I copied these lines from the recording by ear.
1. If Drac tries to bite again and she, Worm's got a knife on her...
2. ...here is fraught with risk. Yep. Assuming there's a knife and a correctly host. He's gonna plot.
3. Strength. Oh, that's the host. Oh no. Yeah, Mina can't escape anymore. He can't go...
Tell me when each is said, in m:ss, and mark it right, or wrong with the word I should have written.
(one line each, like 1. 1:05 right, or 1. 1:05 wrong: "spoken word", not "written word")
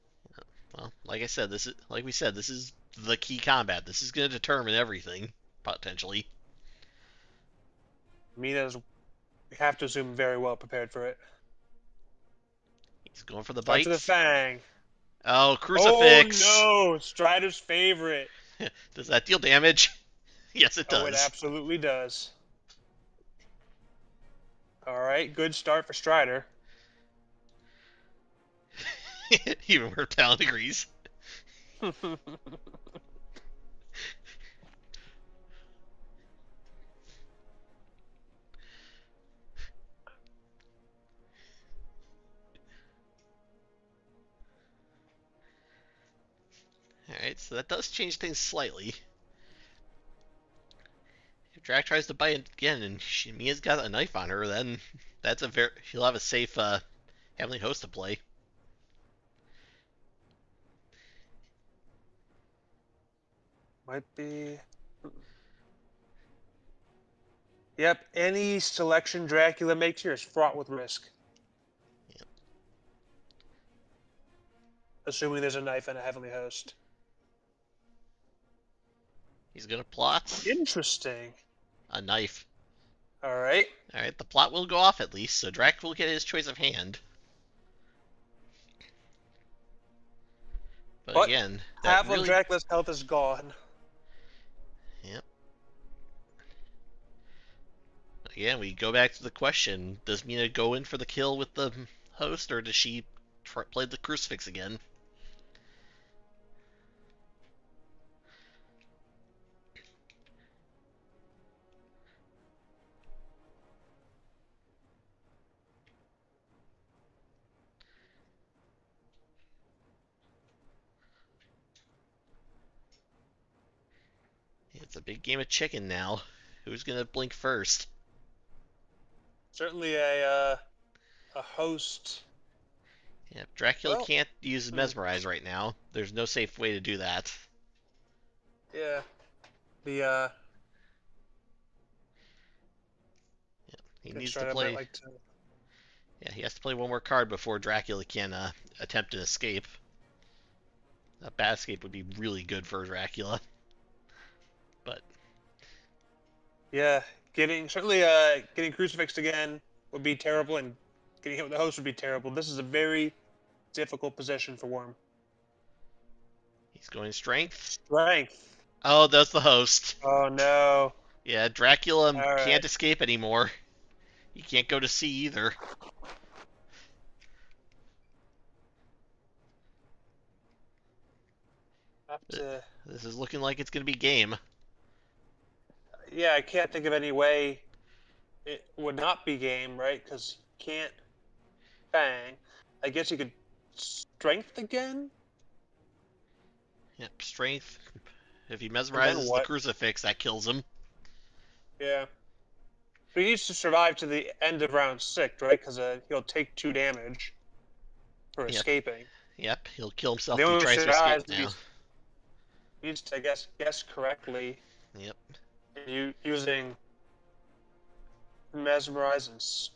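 1. 0:51 wrong: "Mia", not "Worm"
2. 1:10 wrong: "heavenly", not "correctly"
3. 2:47 wrong: "Dracula", not "Mina".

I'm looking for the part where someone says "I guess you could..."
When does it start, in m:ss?
3:12.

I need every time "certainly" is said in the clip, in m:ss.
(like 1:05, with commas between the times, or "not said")
2:09, 2:37.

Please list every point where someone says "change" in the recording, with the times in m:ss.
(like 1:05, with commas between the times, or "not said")
0:47.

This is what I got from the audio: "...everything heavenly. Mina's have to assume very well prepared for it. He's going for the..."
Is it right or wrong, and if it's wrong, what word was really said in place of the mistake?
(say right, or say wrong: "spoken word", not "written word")
wrong: "potentially", not "heavenly".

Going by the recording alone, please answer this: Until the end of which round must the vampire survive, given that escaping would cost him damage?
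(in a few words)
Round 6.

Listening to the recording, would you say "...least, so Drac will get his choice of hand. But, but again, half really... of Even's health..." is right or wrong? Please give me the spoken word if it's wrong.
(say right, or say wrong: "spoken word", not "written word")
wrong: "Dracula", not "Even".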